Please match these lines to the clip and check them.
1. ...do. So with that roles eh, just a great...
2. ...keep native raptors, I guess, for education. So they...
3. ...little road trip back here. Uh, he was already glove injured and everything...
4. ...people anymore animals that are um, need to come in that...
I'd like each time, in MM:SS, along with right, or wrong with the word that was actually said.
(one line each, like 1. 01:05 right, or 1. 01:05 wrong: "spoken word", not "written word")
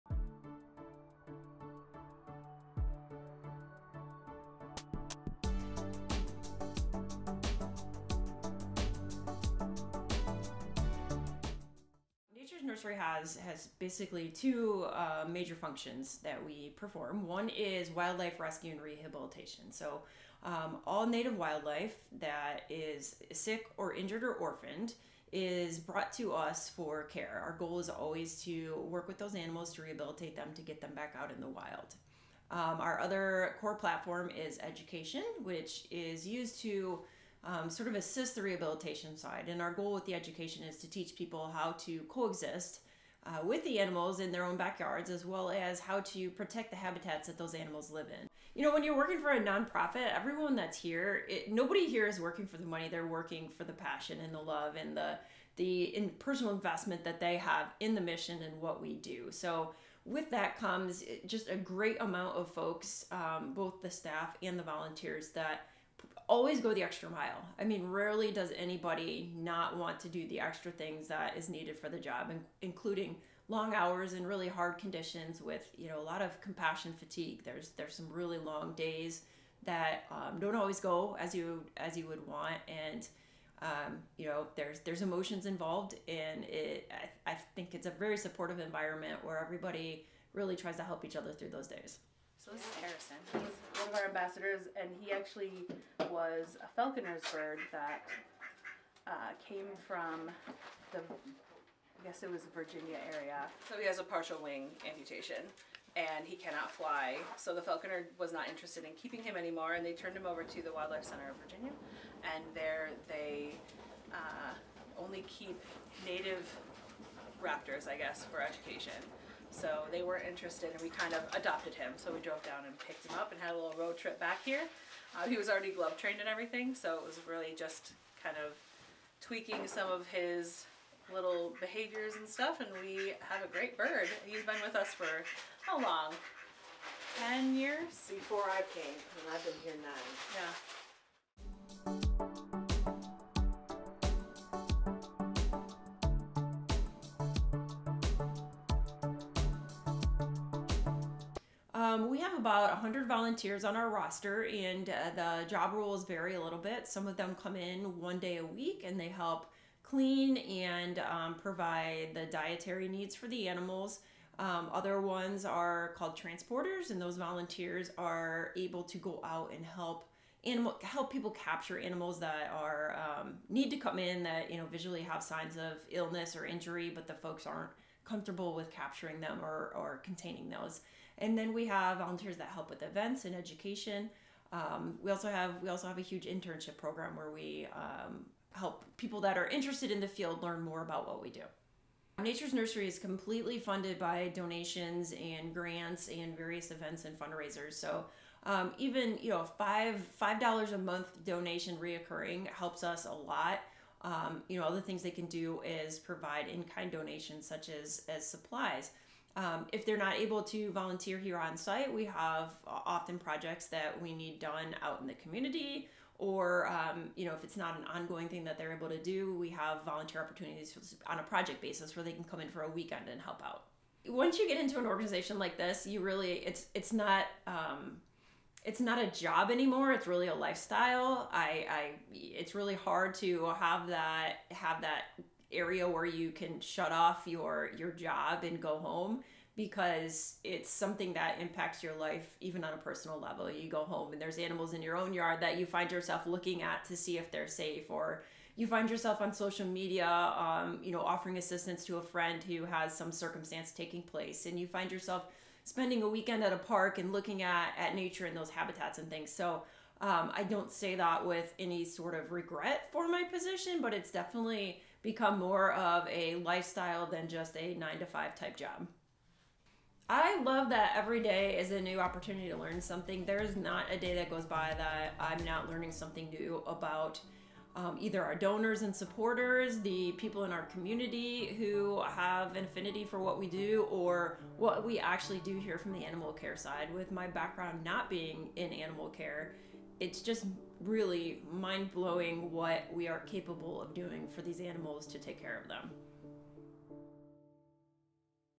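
1. 00:58 wrong: "comes", not "roles"
2. 01:55 right
3. 02:03 wrong: "trained", not "injured"
4. 02:51 wrong: "capture", not "anymore".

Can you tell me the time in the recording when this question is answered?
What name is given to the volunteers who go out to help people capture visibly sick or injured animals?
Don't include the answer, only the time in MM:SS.
02:46.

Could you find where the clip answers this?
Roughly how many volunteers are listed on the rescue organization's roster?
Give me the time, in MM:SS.
02:32.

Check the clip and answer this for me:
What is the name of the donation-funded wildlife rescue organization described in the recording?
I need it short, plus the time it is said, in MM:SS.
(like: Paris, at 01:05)
Nature's Nursery, at 03:12.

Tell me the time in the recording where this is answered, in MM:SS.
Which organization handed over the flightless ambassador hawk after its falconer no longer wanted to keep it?
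01:50.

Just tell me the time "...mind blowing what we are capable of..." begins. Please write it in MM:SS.
04:51.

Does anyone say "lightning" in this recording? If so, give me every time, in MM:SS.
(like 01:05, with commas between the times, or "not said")
not said.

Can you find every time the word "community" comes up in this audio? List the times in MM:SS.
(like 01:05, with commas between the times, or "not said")
03:35, 04:40.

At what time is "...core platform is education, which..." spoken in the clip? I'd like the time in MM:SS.
00:33.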